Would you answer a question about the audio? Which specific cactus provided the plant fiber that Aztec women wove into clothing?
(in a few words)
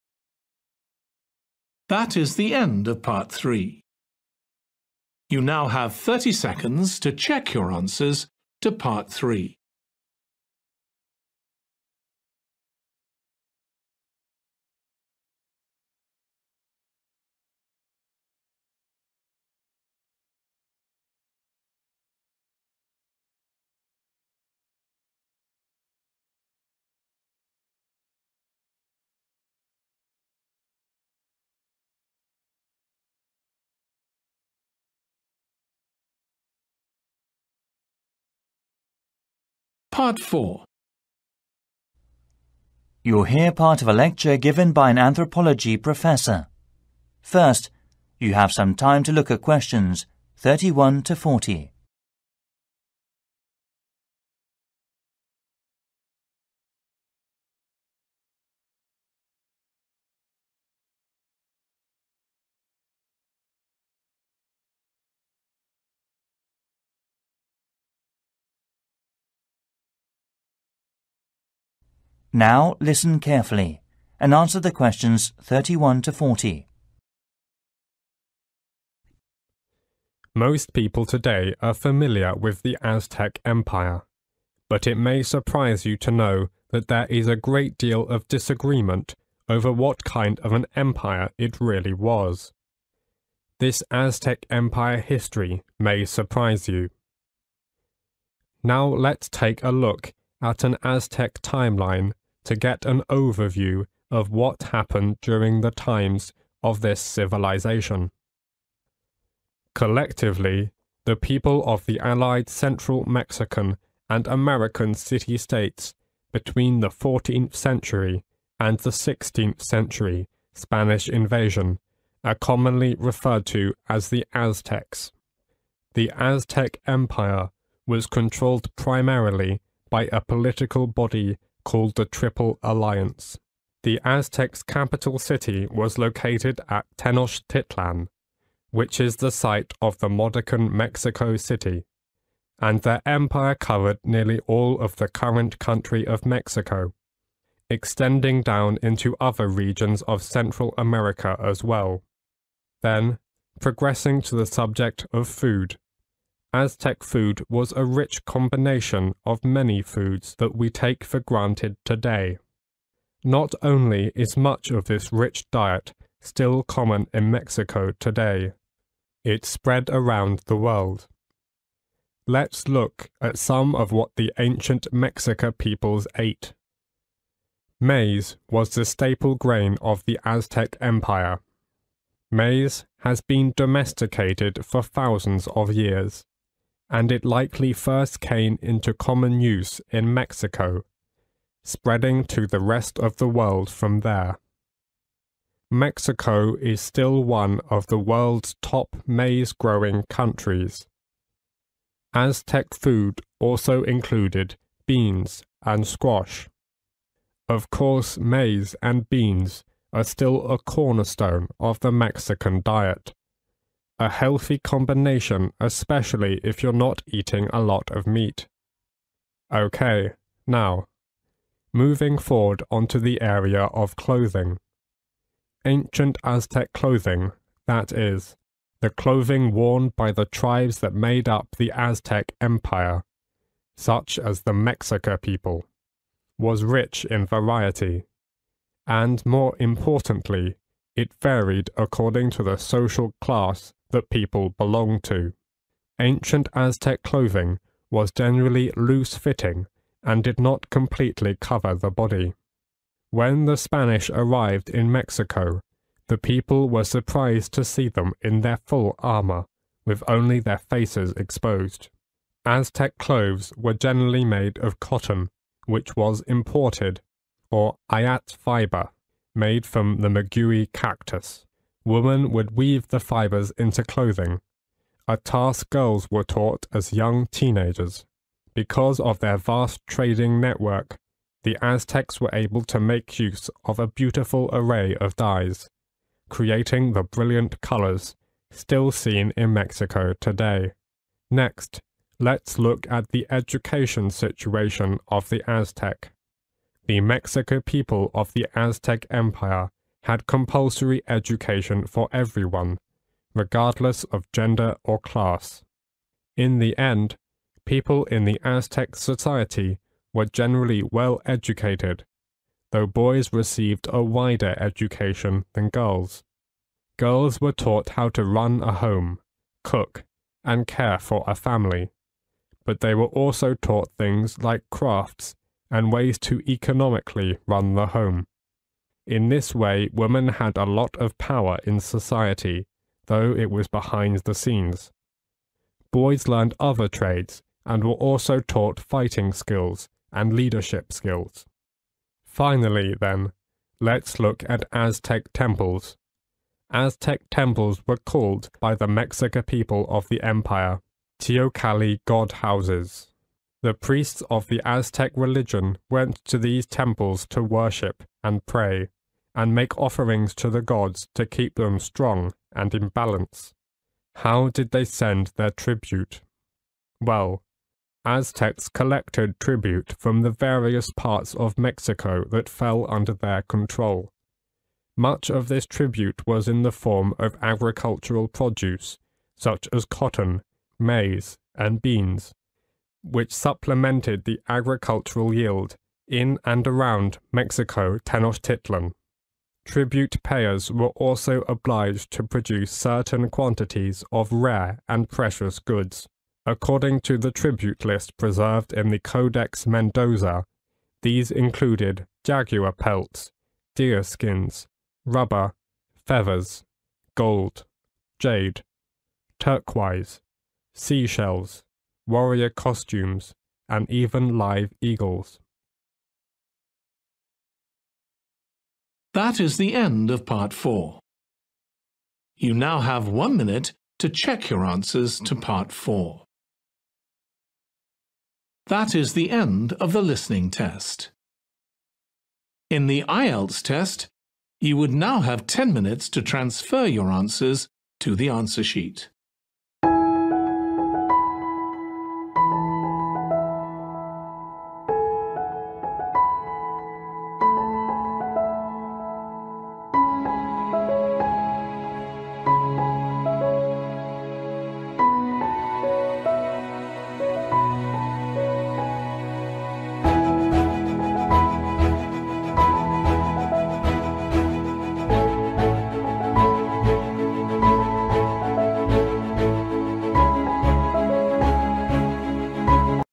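maguey cactus.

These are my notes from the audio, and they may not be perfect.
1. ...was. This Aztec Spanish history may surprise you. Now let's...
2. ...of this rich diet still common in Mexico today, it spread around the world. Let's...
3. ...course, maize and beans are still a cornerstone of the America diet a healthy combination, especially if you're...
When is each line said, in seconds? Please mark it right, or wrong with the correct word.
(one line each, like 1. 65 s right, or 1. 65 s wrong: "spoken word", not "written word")
1. 91 s wrong: "Empire", not "Spanish"
2. 164 s right
3. 207 s wrong: "Mexican", not "America".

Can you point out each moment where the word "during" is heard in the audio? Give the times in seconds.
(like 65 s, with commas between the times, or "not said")
105 s.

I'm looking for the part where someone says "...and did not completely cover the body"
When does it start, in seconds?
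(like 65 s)
250 s.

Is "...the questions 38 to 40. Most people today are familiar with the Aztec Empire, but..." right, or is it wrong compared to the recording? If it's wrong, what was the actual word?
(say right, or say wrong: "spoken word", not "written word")
wrong: "31", not "38".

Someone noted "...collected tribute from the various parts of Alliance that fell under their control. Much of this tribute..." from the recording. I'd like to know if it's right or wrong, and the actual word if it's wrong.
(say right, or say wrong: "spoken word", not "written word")
wrong: "Mexico", not "Alliance".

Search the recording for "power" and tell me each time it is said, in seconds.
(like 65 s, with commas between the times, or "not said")
331 s.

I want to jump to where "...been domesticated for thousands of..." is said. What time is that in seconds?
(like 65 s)
183 s.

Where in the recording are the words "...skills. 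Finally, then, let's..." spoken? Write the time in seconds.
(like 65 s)
340 s.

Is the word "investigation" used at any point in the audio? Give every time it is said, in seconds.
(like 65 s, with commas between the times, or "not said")
not said.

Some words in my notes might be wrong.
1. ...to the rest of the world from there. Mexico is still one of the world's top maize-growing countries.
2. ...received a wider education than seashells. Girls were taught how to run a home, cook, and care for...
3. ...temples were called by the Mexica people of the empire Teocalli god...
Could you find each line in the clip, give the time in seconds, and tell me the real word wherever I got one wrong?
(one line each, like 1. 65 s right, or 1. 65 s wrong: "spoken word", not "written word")
1. 192 s right
2. 313 s wrong: "girls", not "seashells"
3. 347 s right.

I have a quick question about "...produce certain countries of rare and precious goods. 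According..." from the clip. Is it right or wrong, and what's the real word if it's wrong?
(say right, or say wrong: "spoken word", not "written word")
wrong: "quantities", not "countries".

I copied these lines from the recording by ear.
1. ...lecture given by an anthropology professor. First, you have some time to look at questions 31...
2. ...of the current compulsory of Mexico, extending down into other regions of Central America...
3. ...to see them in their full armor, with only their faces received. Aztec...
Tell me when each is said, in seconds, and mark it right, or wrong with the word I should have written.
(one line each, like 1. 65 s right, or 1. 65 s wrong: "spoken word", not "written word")
1. 43 s right
2. 144 s wrong: "country", not "compulsory"
3. 257 s wrong: "exposed", not "received".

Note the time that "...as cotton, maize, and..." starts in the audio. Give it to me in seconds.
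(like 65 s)
379 s.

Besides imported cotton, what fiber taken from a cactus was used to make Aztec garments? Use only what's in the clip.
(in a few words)
ayate fiber.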